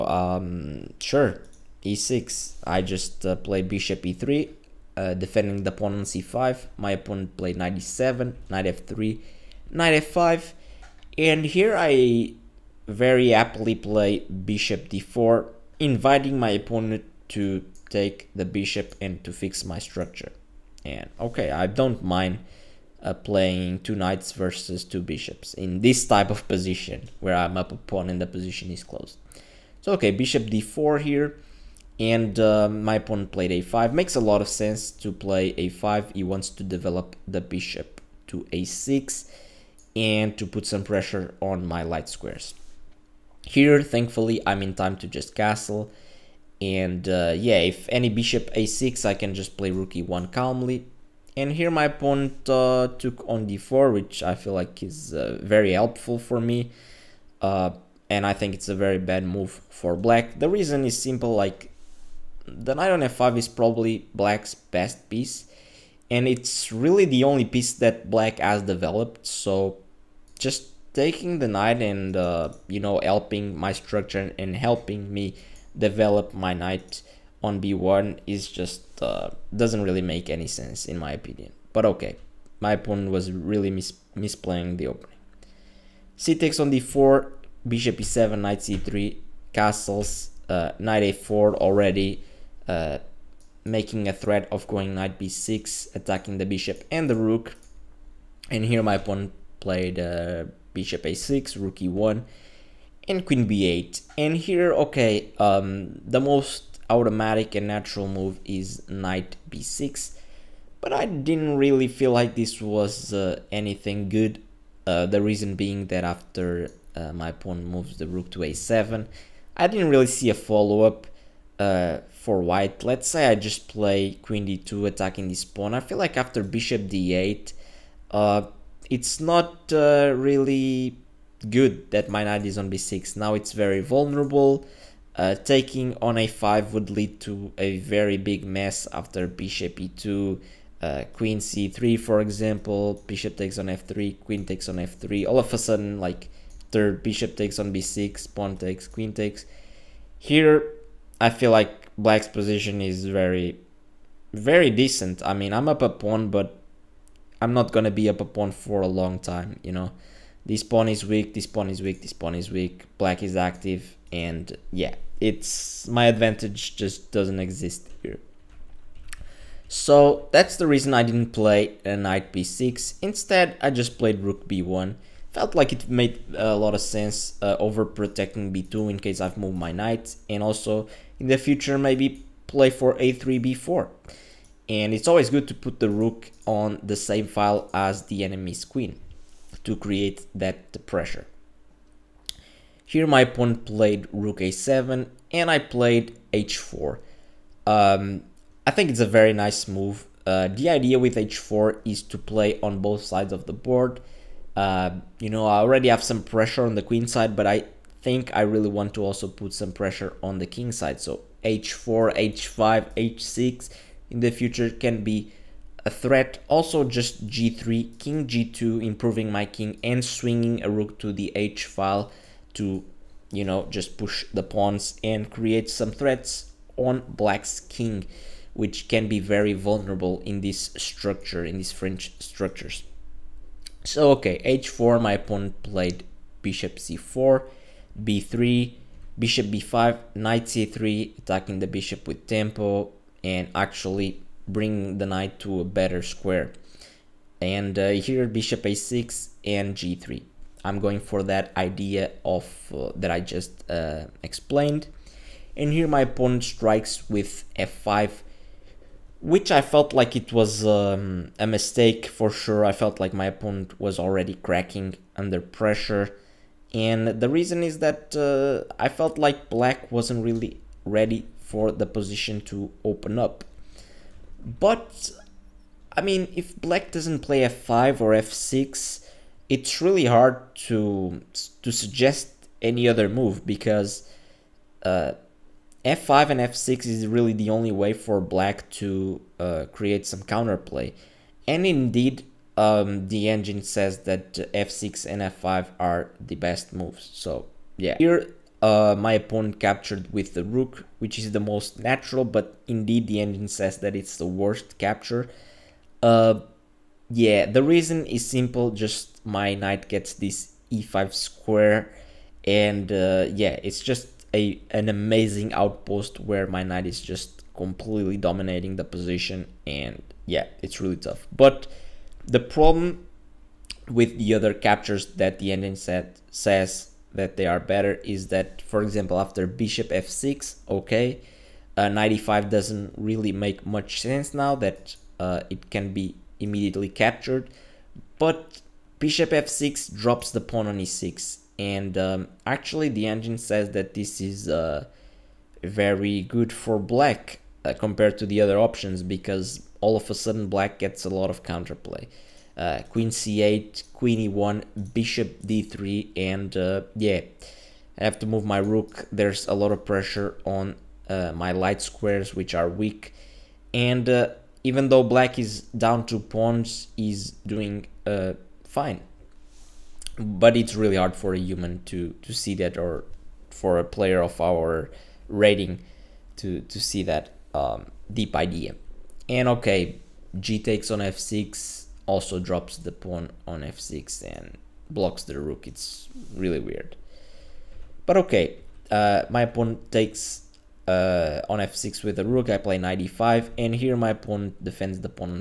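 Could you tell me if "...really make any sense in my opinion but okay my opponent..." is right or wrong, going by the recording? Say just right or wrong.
right.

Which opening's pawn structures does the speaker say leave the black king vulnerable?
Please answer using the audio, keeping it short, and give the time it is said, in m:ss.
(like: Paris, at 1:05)
French, at 3:51.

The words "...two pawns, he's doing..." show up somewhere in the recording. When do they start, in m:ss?
6:06.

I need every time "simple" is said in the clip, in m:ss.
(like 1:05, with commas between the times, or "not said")
1:01, 5:08.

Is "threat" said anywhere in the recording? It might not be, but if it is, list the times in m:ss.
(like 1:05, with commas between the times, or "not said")
1:34, 3:35, 3:45.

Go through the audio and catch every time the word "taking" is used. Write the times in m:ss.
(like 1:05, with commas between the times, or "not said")
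1:10, 2:15.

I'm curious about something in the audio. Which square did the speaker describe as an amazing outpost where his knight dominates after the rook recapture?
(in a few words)
e5.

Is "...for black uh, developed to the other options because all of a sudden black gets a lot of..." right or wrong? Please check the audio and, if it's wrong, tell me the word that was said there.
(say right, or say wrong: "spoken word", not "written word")
wrong: "compared", not "developed".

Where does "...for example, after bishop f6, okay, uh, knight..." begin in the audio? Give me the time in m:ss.
5:28.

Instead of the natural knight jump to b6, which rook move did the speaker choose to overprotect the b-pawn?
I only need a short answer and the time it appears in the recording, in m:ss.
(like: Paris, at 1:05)
Rook b1, at 2:54.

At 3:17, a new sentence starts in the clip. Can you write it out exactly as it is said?
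Um, I think it's a very nice move.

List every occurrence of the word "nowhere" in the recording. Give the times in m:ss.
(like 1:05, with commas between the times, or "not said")
not said.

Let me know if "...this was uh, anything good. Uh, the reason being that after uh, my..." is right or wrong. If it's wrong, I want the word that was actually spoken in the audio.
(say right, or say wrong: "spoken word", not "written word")
right.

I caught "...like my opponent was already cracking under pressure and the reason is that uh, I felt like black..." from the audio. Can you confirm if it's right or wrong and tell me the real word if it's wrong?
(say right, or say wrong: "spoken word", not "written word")
right.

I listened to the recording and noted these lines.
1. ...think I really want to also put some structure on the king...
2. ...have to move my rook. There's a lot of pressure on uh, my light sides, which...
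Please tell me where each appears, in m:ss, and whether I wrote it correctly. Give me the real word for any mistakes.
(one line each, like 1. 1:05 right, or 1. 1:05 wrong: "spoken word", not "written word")
1. 3:28 wrong: "pressure", not "structure"
2. 5:58 wrong: "squares", not "sides".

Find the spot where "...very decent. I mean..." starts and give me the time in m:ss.
2:34.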